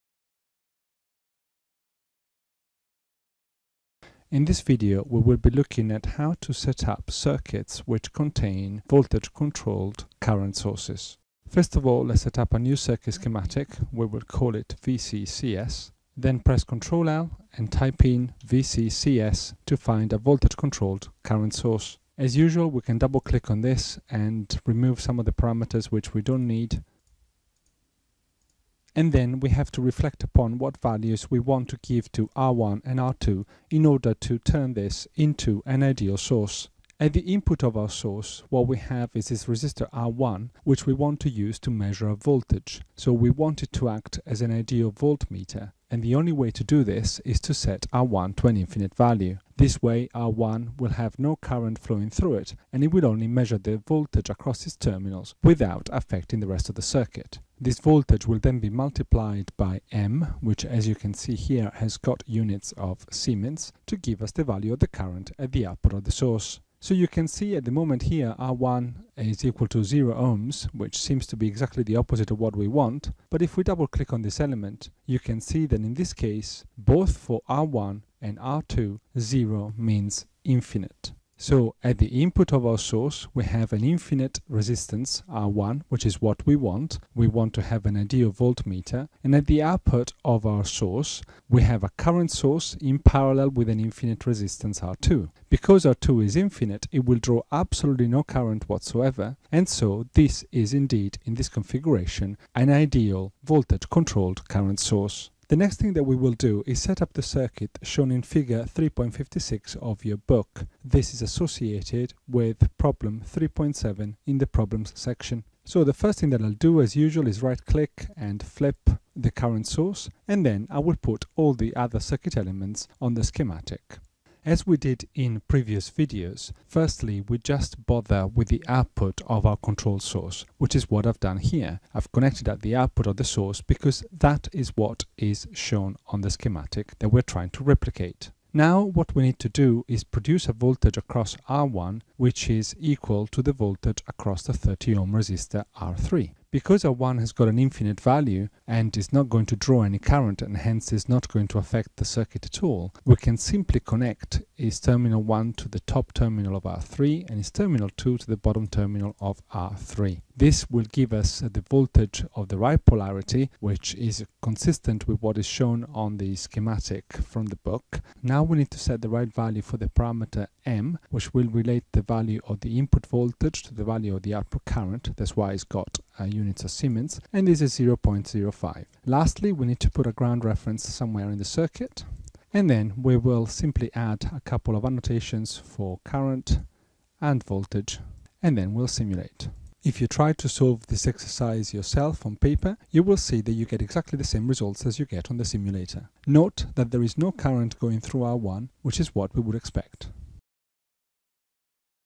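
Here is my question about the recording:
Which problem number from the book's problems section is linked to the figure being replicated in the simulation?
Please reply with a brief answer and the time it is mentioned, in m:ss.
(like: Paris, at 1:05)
3.7, at 1:52.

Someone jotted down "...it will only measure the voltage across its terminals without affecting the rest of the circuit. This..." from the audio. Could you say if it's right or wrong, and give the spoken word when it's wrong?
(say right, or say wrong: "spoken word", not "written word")
right.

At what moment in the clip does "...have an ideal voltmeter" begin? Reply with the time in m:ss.
1:27.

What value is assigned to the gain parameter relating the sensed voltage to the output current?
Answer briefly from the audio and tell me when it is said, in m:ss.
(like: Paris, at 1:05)
0.05, at 2:57.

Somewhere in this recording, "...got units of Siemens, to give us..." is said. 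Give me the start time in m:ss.
1:01.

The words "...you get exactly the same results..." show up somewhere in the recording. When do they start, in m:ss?
3:13.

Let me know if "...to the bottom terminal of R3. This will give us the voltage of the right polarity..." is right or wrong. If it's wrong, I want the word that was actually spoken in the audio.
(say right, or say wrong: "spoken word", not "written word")
right.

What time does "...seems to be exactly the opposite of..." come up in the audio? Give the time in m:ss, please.
1:10.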